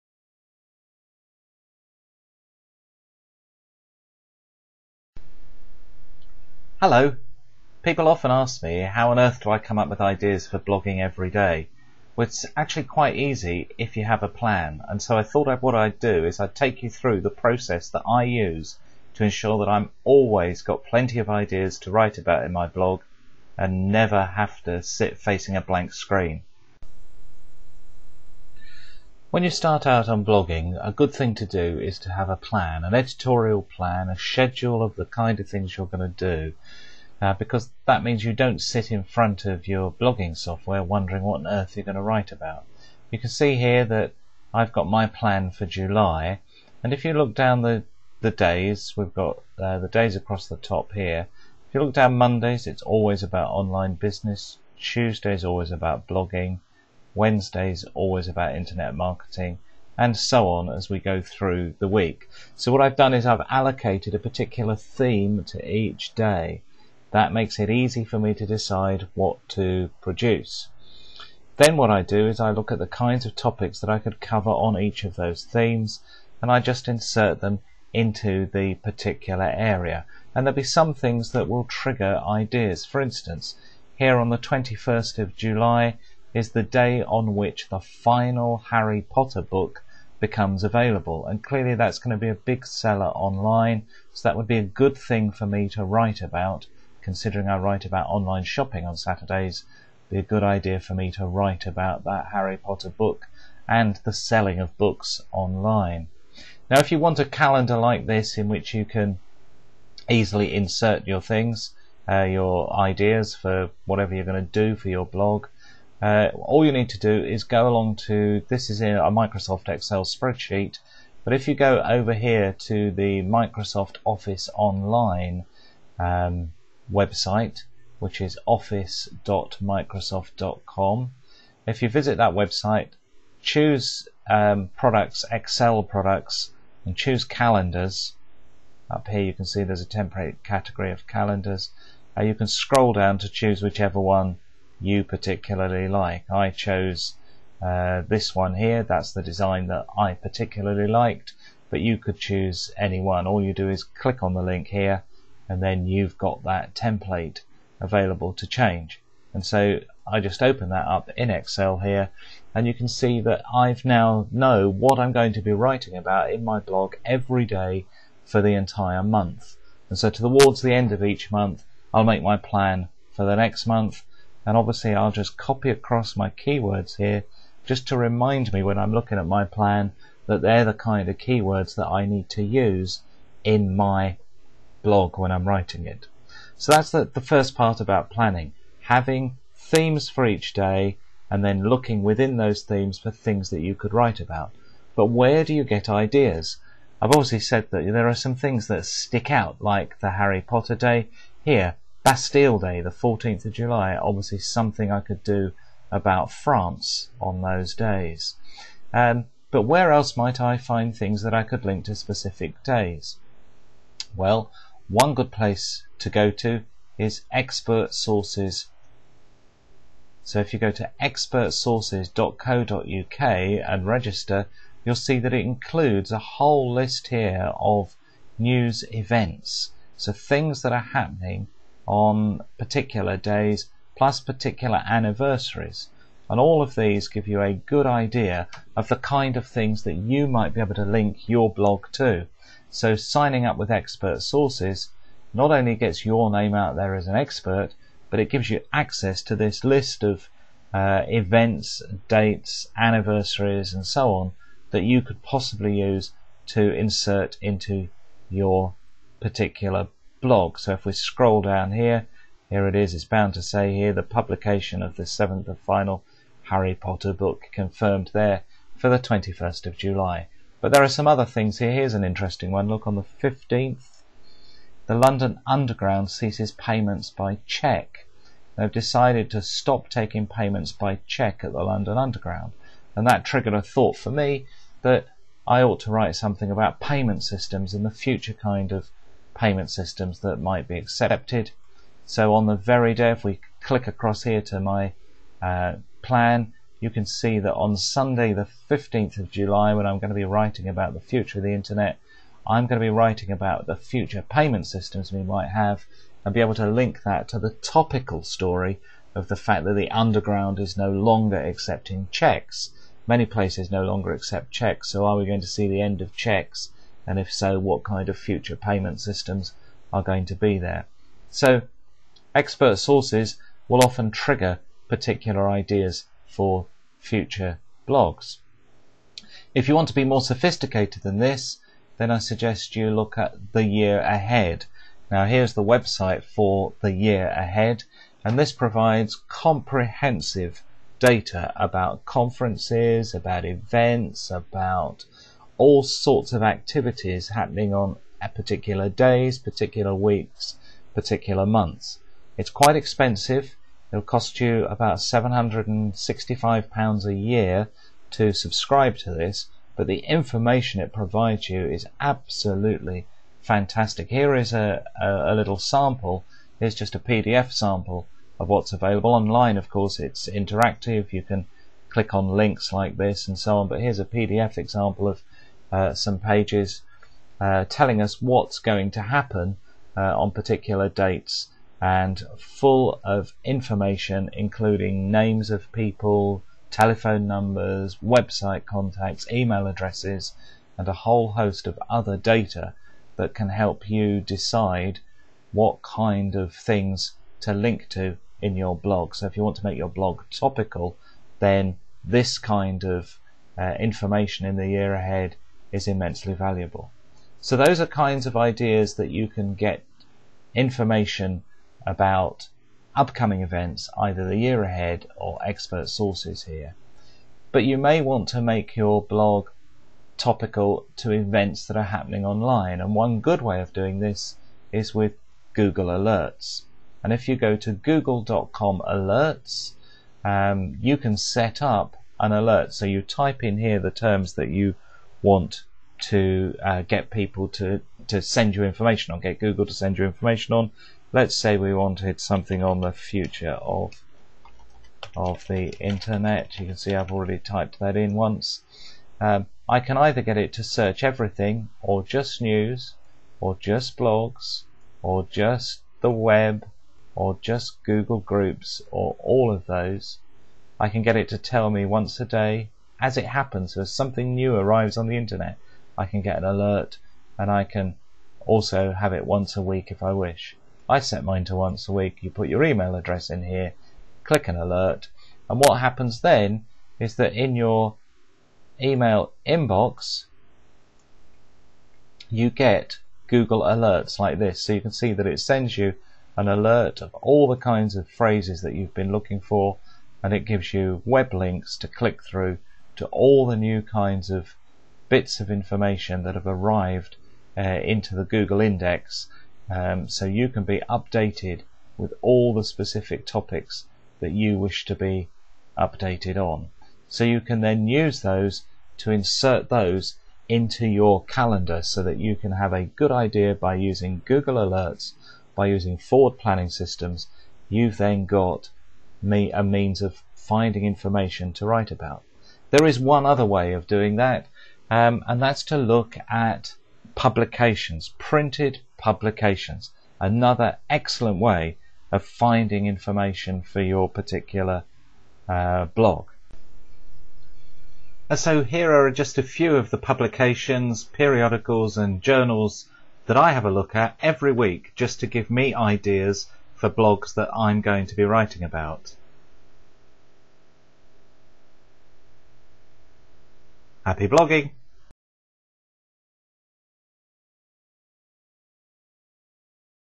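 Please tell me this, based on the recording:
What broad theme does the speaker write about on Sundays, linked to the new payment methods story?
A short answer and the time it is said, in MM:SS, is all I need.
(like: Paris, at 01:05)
The future of the internet, at 05:00.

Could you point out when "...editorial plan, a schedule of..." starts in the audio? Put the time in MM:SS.
00:32.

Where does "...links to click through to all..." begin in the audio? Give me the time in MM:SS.
08:11.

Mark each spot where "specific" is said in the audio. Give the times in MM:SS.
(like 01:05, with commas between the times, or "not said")
03:31, 08:22.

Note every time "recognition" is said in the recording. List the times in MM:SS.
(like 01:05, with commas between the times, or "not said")
not said.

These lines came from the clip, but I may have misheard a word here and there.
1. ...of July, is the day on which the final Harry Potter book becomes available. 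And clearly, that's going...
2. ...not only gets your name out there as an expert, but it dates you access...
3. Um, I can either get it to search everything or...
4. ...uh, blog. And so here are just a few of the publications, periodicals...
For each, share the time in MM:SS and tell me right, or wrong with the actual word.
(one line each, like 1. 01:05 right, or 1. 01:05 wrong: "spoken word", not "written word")
1. 01:25 right
2. 04:05 wrong: "gives", not "dates"
3. 07:29 right
4. 08:55 right.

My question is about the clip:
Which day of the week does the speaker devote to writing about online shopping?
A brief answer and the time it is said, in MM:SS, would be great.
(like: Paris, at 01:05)
Saturdays, at 01:38.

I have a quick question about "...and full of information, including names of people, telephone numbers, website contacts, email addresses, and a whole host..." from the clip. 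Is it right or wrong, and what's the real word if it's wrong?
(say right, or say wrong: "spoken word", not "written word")
right.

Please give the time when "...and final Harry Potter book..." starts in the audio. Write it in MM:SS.
04:25.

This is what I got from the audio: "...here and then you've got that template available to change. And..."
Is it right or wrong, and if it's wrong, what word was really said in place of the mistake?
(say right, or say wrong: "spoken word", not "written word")
right.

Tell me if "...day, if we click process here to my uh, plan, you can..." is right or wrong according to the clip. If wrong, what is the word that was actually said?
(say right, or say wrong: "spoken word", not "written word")
wrong: "across", not "process".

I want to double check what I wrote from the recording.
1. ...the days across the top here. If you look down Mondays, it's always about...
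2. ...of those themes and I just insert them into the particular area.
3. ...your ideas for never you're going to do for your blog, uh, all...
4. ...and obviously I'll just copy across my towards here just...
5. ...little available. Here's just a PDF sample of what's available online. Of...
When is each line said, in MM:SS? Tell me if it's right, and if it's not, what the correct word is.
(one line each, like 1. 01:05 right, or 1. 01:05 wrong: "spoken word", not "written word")
1. 00:49 right
2. 01:15 right
3. 01:52 wrong: "whatever", not "never"
4. 02:54 wrong: "keywords", not "towards"
5. 06:05 wrong: "sample", not "available".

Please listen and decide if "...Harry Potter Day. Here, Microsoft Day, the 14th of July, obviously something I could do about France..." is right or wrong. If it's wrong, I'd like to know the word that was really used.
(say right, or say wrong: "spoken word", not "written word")
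wrong: "Bastille", not "Microsoft".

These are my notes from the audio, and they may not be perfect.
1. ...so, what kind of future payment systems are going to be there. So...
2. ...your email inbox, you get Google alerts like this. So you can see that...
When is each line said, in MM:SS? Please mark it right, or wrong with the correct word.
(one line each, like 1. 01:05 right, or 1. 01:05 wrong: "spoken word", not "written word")
1. 05:17 right
2. 07:57 right.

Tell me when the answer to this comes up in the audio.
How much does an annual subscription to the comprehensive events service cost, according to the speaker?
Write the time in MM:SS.
05:54.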